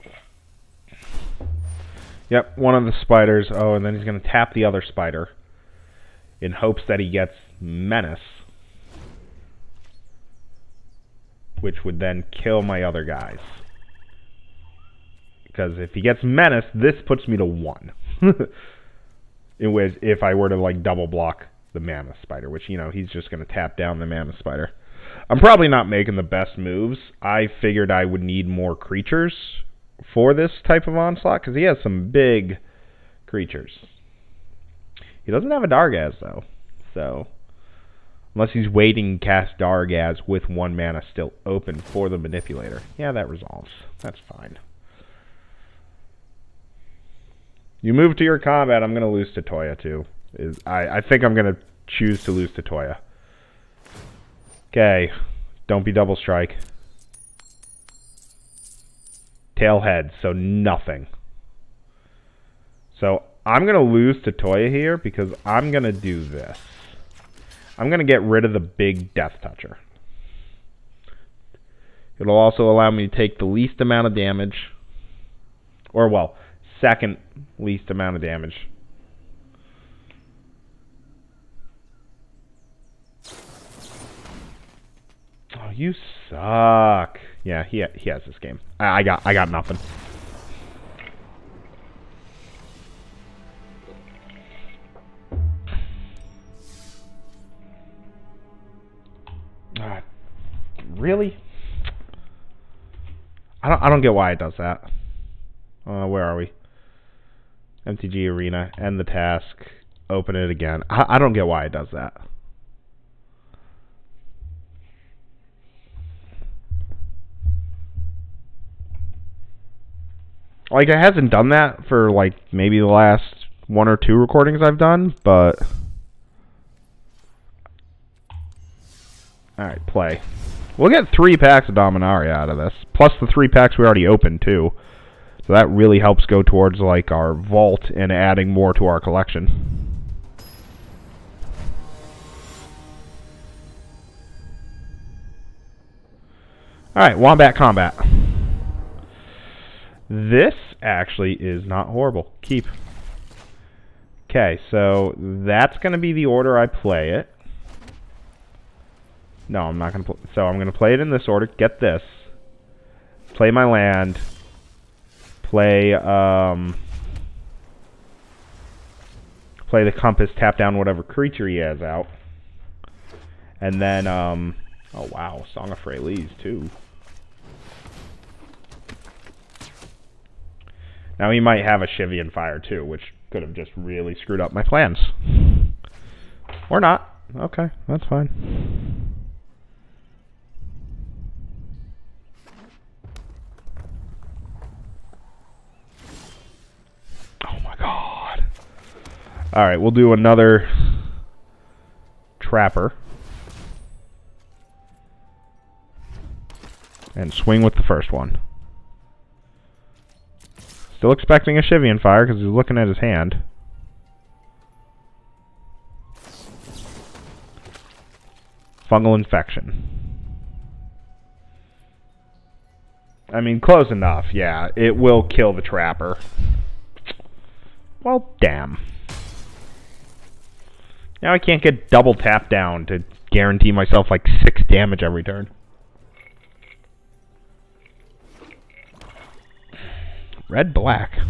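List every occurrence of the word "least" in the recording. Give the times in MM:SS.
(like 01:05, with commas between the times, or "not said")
01:13, 01:17.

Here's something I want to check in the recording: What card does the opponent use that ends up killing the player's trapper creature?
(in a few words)
Fungal Infection.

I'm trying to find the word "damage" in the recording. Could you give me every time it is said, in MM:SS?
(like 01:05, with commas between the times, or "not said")
01:14, 01:18, 03:54.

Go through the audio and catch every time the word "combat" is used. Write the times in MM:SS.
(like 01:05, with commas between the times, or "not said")
00:48, 02:27.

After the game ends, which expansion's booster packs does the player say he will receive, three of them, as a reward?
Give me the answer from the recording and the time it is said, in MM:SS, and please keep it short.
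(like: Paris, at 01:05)
Dominaria, at 02:11.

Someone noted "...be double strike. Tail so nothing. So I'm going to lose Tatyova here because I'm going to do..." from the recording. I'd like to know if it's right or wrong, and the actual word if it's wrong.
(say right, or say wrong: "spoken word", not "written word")
right.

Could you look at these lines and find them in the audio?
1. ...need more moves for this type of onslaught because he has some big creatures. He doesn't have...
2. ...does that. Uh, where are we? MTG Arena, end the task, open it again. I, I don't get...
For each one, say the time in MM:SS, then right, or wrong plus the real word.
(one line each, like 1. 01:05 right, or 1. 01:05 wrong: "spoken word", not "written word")
1. 00:28 wrong: "creatures", not "moves"
2. 01:44 right.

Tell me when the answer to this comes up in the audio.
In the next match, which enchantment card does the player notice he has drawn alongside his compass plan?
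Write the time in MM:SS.
02:55.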